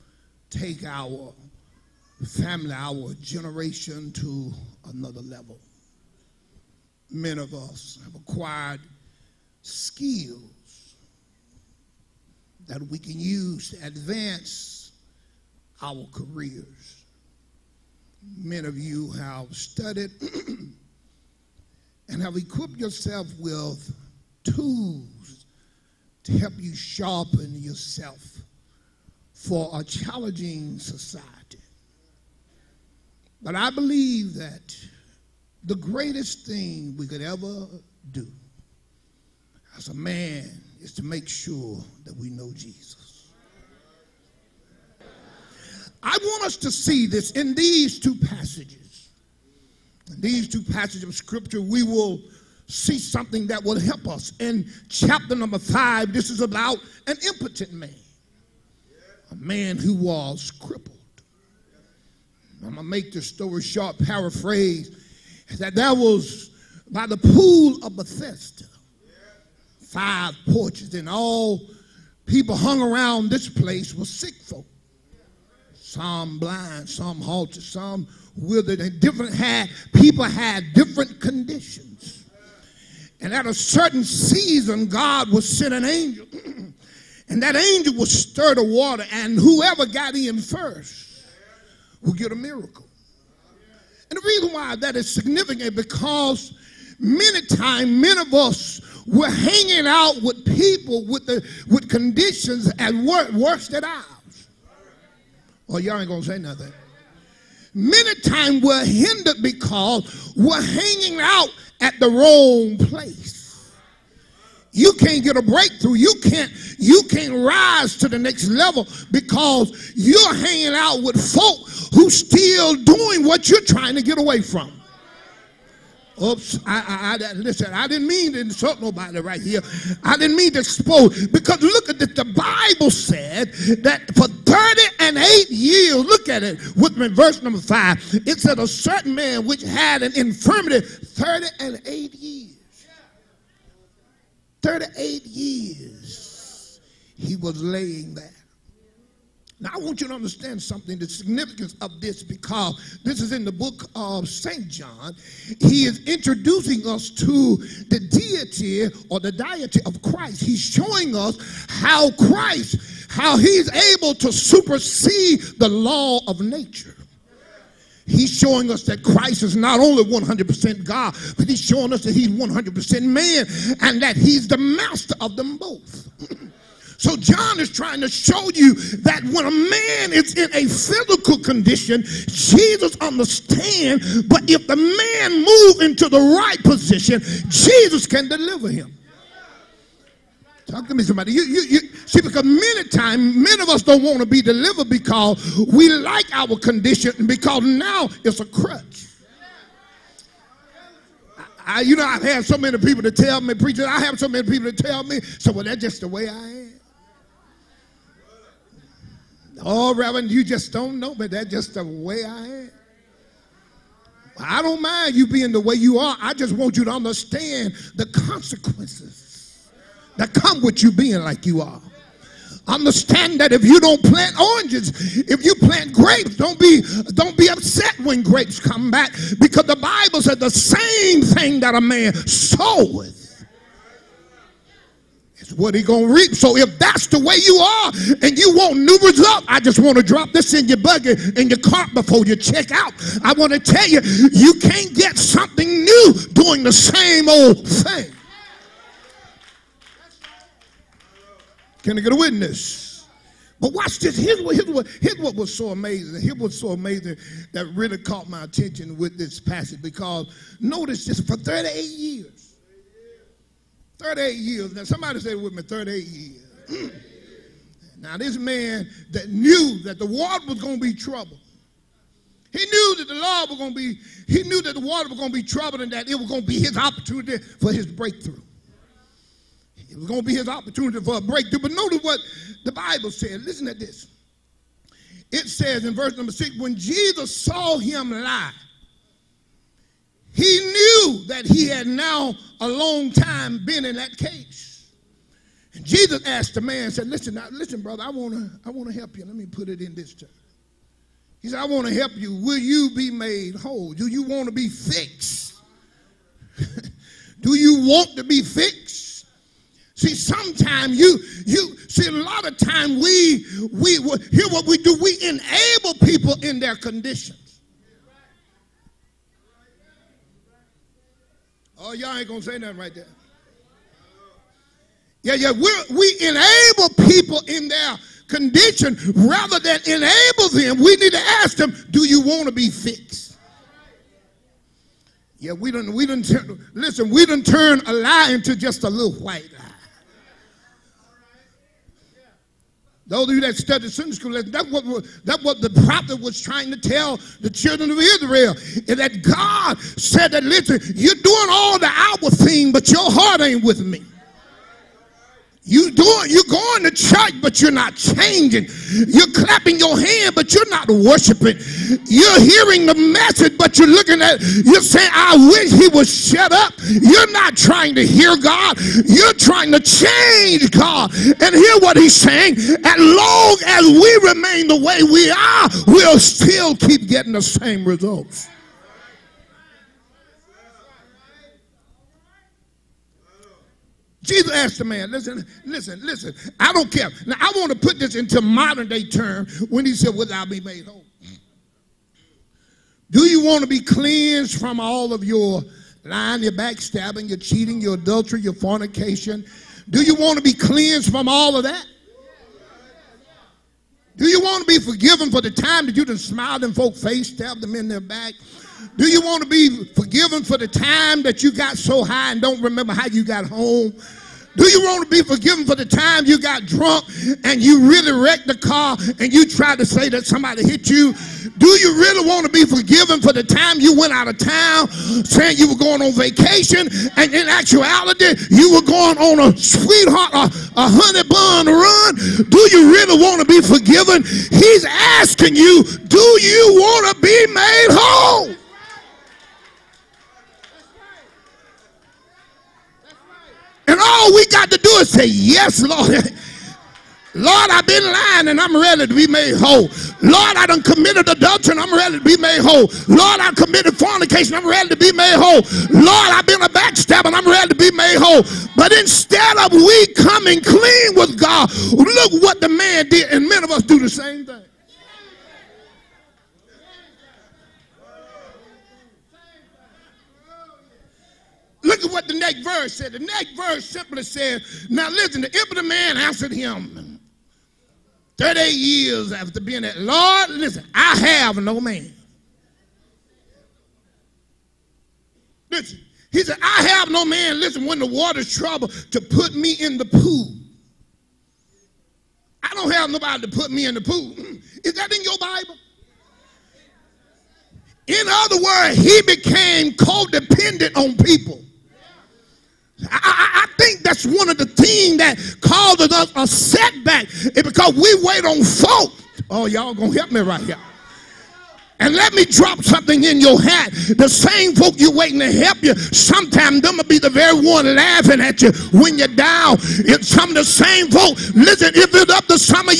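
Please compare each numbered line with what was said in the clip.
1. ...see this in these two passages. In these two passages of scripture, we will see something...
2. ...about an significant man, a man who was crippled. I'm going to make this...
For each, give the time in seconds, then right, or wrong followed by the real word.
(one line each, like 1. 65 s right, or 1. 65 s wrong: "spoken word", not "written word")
1. 46 s right
2. 56 s wrong: "impotent", not "significant".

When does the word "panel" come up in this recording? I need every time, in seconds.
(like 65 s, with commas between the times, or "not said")
not said.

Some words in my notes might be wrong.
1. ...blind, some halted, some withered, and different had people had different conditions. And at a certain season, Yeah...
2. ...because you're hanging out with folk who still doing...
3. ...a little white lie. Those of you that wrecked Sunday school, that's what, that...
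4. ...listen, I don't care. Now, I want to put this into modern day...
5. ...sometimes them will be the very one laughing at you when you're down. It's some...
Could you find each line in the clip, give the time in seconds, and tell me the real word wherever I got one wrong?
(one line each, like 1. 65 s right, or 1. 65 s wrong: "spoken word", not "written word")
1. 76 s wrong: "God", not "Yeah"
2. 119 s right
3. 338 s wrong: "studied", not "wrecked"
4. 386 s right
5. 515 s right.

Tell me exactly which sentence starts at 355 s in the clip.
You doing you going to church, but you're not changing.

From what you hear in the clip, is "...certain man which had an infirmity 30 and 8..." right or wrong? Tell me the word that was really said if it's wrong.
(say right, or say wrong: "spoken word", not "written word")
right.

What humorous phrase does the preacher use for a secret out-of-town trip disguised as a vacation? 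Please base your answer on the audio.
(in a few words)
honey bun run.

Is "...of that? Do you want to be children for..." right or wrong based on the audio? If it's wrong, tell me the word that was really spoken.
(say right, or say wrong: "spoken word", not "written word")
wrong: "forgiven", not "children".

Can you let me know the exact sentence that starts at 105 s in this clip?
Or oh, y'all ain't going to say nothing many times were hindered because we're hanging out at the wrong place.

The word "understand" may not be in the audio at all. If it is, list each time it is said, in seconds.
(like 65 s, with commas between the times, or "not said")
150 s, 183 s, 216 s, 222 s.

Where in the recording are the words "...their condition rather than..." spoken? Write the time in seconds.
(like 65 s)
327 s.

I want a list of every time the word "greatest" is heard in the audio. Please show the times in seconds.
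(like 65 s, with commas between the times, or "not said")
35 s.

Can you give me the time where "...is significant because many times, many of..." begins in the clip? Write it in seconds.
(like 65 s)
94 s.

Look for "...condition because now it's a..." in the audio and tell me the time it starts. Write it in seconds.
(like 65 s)
196 s.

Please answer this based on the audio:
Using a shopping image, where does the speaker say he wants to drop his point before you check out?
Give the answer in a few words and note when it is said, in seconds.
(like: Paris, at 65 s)
buggy, at 240 s.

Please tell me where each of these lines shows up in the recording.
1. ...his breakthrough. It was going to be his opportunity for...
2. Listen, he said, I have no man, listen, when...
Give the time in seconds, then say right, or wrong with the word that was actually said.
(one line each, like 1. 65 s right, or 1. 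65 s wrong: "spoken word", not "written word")
1. 277 s right
2. 485 s right.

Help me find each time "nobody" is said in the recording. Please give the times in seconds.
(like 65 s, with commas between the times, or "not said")
128 s, 493 s.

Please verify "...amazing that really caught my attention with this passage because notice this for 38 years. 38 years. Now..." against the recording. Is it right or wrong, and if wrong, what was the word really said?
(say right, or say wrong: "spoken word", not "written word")
right.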